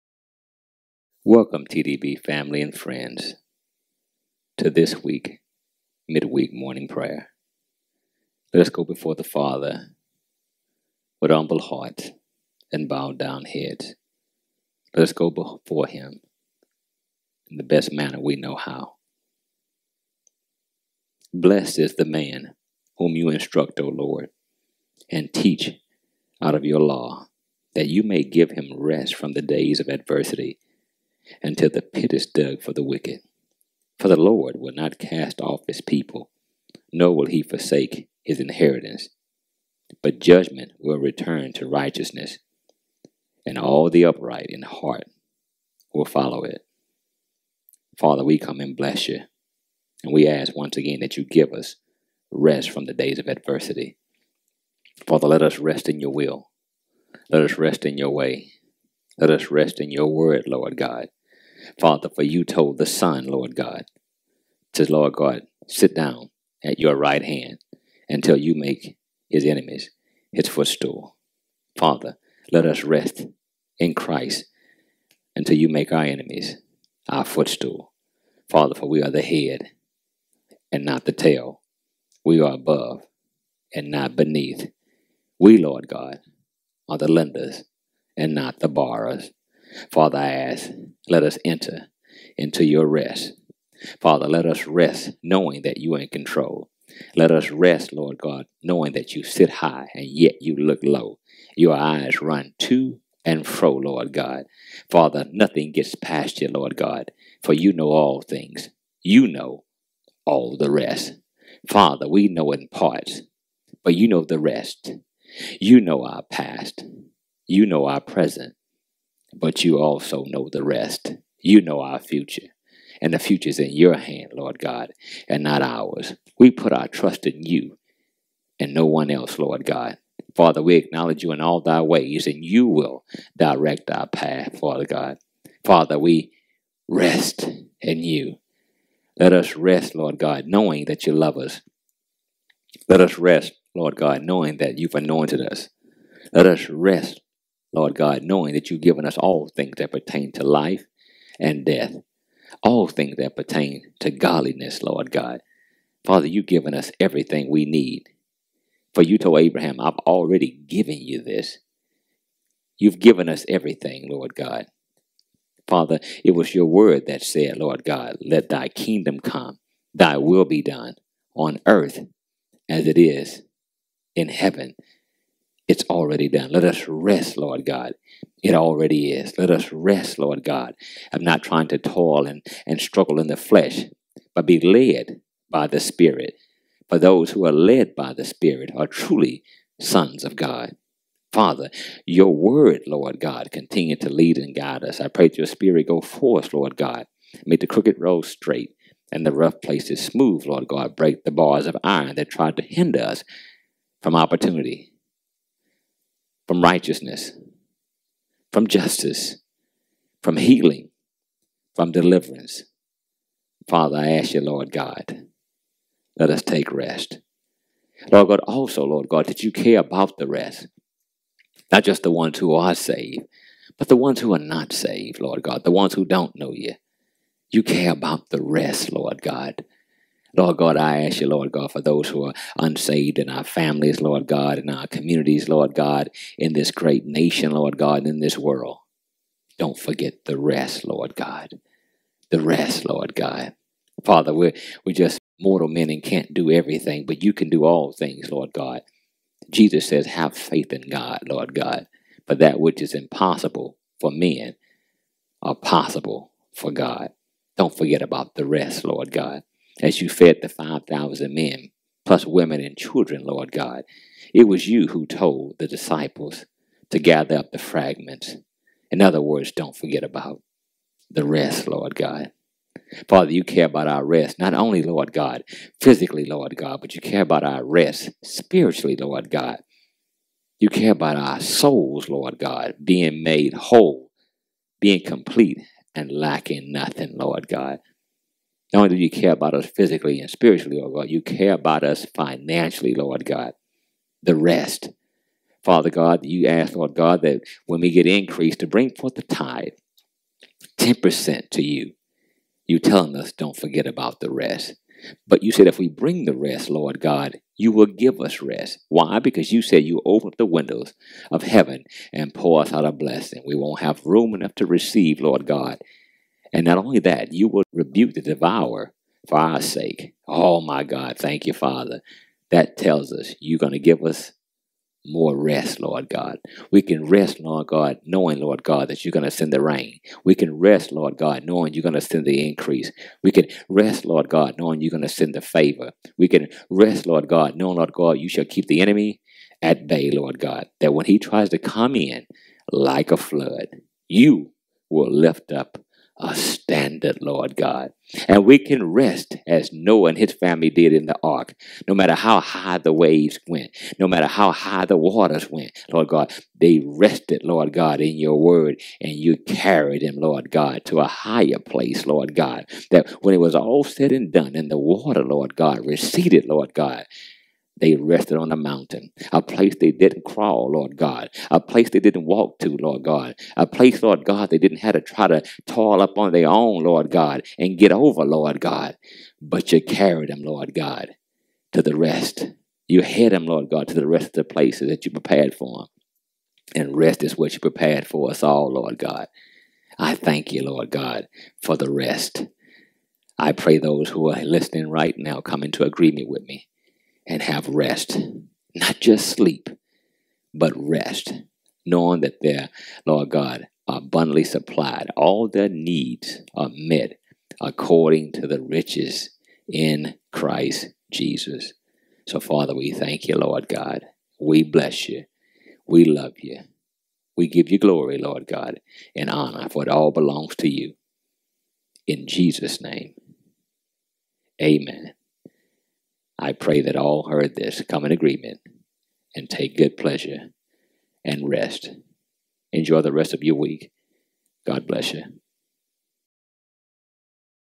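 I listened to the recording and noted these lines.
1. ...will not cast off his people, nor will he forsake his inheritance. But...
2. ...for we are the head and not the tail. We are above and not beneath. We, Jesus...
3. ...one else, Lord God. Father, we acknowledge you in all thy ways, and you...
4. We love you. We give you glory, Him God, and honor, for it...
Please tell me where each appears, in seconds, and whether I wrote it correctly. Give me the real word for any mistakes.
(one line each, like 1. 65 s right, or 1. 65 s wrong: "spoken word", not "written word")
1. 34 s right
2. 78 s wrong: "Lord", not "Jesus"
3. 128 s right
4. 415 s wrong: "Lord", not "Him".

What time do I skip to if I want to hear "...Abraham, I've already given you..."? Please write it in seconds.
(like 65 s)
159 s.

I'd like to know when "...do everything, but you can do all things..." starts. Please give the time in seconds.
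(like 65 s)
246 s.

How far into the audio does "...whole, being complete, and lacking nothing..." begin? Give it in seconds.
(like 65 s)
283 s.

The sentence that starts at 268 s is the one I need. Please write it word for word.
In other words, don't forget about the rest, Lord God.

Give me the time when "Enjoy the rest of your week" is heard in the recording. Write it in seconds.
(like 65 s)
432 s.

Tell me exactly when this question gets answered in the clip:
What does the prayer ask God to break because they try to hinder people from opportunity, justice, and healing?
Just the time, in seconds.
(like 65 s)
201 s.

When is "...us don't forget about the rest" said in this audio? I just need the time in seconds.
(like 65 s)
303 s.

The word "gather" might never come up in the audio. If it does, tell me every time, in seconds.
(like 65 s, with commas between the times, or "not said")
266 s.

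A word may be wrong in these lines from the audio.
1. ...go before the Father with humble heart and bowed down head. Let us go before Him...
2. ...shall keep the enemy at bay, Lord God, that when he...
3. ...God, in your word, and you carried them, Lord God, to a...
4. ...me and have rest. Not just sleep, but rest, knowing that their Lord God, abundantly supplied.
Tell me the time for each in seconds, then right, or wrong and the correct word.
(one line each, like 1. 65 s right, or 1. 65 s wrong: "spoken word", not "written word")
1. 8 s right
2. 338 s right
3. 357 s right
4. 396 s right.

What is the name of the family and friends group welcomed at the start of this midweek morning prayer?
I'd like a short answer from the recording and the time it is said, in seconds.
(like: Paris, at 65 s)
TDB, at 1 s.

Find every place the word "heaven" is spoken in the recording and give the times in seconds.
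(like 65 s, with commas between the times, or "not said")
174 s, 311 s.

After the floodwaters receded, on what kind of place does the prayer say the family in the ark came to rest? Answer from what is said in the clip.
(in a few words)
a mountain.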